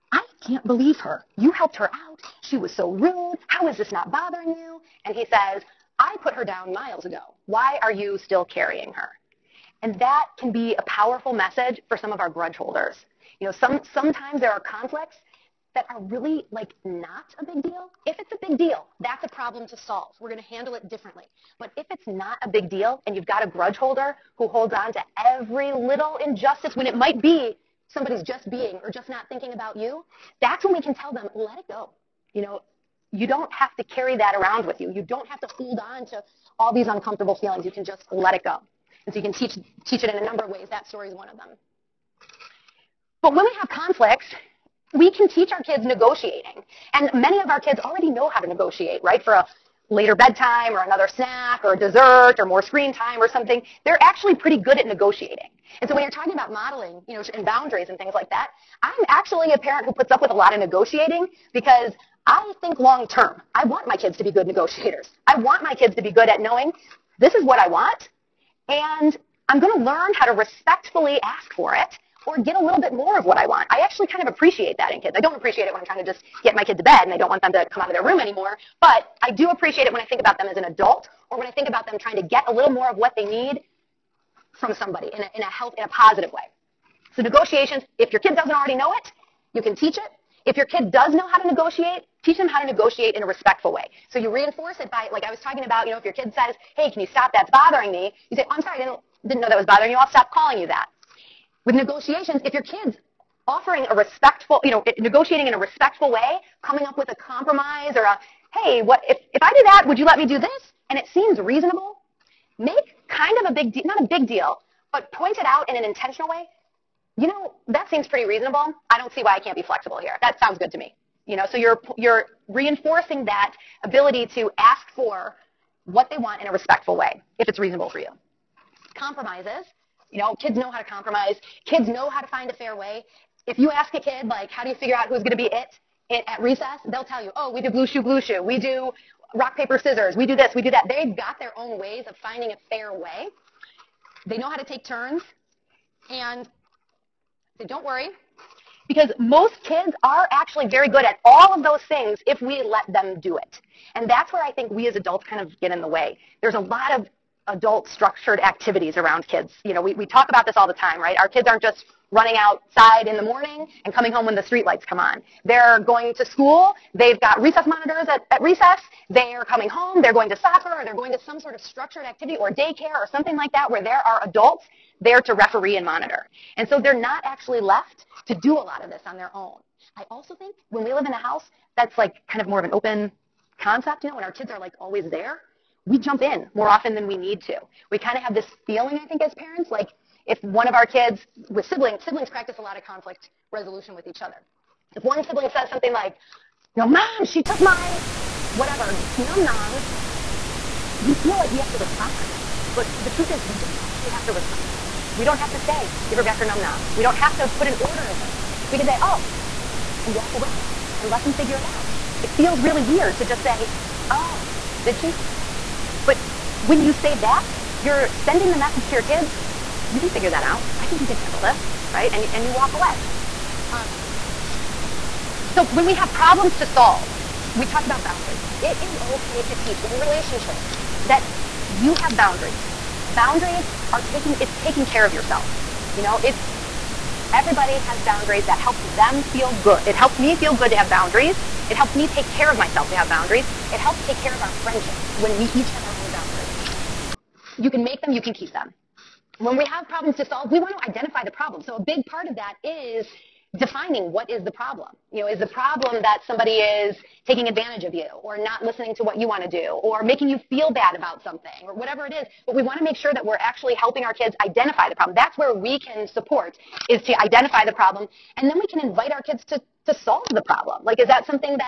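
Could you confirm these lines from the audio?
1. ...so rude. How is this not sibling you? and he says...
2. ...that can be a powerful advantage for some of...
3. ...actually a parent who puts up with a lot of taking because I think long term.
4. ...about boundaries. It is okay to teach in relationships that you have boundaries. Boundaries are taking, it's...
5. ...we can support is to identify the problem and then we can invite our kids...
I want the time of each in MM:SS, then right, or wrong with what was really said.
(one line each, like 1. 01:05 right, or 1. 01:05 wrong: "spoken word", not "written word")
1. 00:02 wrong: "bothering", not "sibling"
2. 00:09 wrong: "message", not "advantage"
3. 00:59 wrong: "negotiating", not "taking"
4. 03:47 right
5. 04:25 right.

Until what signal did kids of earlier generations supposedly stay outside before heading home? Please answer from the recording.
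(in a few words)
street lights come on.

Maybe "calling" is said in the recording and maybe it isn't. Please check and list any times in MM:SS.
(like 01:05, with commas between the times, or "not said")
01:40.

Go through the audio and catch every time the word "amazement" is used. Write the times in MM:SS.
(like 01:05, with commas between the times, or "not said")
not said.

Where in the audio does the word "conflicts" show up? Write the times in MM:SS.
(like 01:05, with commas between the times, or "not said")
00:14, 00:43, 03:12.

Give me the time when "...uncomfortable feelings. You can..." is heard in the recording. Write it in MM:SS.
00:36.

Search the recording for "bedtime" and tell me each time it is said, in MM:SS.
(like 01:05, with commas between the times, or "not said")
00:50.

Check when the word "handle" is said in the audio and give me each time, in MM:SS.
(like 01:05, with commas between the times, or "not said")
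00:20, 03:41.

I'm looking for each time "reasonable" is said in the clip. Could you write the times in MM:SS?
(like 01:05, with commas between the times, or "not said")
01:51, 01:58, 02:07.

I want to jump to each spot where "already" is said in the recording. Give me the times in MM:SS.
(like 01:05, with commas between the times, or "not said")
00:47, 01:28.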